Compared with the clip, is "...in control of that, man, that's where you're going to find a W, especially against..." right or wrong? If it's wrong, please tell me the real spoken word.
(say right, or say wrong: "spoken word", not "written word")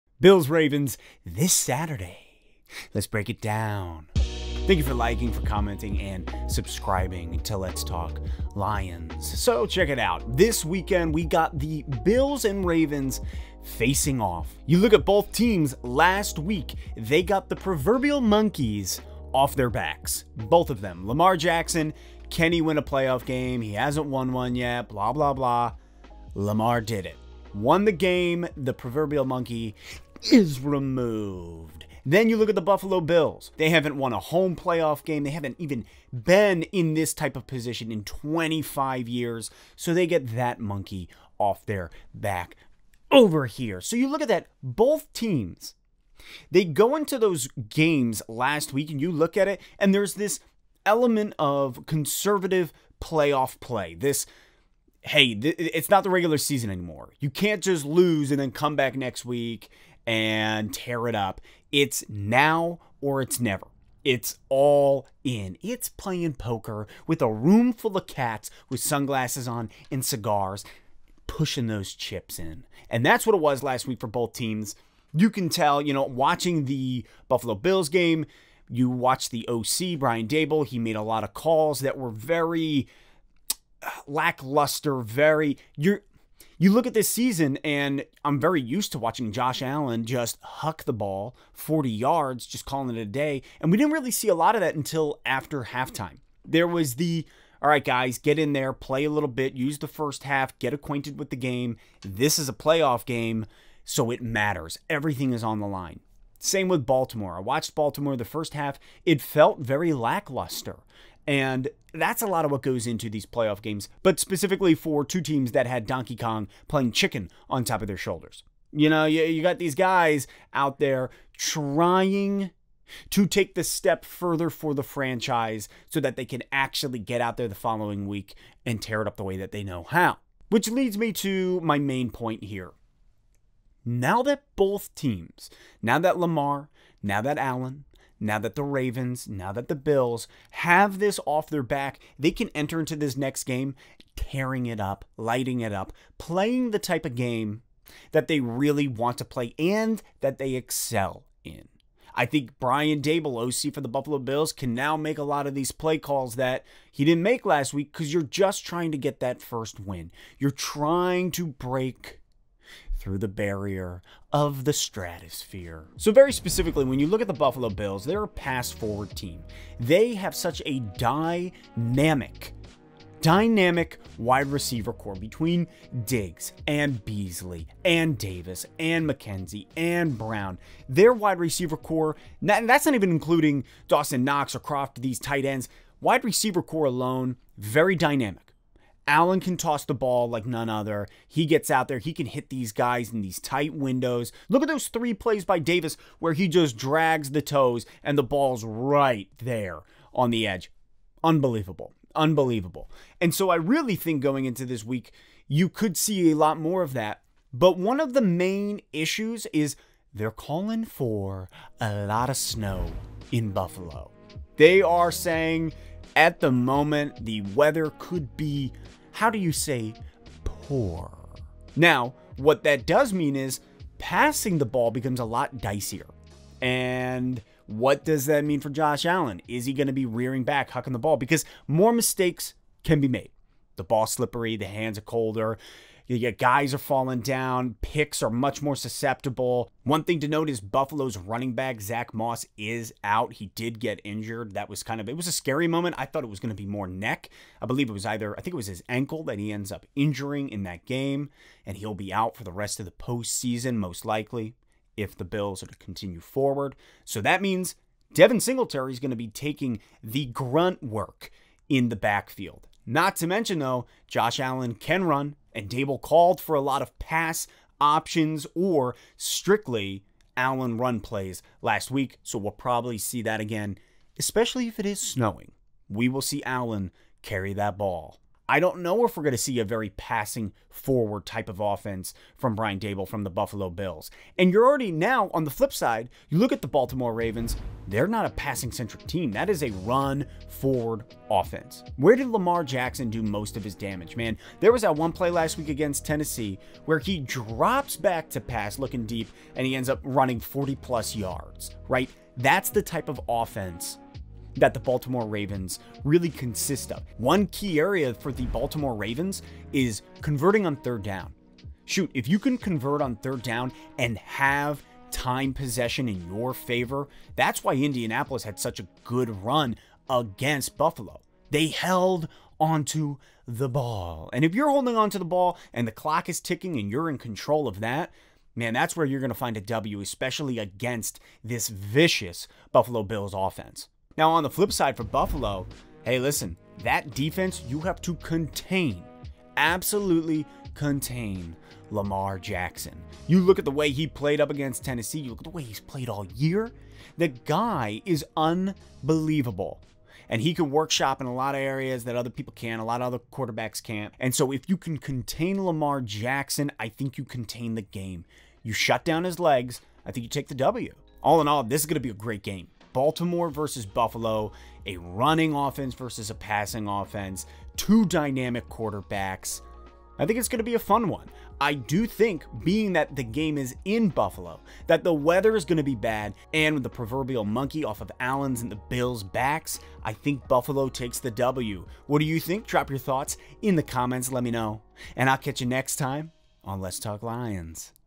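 right.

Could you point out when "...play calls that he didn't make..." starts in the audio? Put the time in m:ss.
2:35.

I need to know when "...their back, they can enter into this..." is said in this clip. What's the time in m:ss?
2:21.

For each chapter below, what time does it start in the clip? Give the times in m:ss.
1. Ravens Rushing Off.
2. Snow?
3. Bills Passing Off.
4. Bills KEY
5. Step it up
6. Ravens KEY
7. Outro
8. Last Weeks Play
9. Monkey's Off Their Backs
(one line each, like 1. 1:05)
1. 4:45
2. 3:30
3. 2:45
4. 5:34
5. 2:10
6. 5:07
7. 6:01
8. 0:48
9. 0:15.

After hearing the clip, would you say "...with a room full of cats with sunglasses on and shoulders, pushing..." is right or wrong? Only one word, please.
wrong.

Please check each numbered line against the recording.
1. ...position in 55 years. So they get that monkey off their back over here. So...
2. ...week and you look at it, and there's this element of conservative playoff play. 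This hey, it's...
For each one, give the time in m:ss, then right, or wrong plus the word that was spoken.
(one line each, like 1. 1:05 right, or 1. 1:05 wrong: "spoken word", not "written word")
1. 0:37 wrong: "25", not "55"
2. 0:48 right.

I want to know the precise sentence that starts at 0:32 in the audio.
Then you look at the Buffalo Bills.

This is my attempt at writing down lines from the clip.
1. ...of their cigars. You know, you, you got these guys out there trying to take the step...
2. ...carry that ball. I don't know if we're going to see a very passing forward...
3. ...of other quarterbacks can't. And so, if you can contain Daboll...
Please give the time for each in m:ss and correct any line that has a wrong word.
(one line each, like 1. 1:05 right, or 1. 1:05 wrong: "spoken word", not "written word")
1. 1:57 wrong: "shoulders", not "cigars"
2. 4:37 right
3. 5:53 wrong: "Lamar", not "Daboll".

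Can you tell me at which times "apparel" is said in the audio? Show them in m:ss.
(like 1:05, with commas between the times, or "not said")
not said.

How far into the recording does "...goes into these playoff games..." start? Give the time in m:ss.
1:52.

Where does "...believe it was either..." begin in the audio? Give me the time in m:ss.
4:07.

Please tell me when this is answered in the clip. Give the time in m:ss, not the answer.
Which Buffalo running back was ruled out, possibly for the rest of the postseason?
4:01.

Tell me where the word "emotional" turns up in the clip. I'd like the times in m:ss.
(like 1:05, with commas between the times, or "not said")
not said.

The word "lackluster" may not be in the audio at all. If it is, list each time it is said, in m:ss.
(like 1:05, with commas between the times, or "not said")
1:24, 1:49.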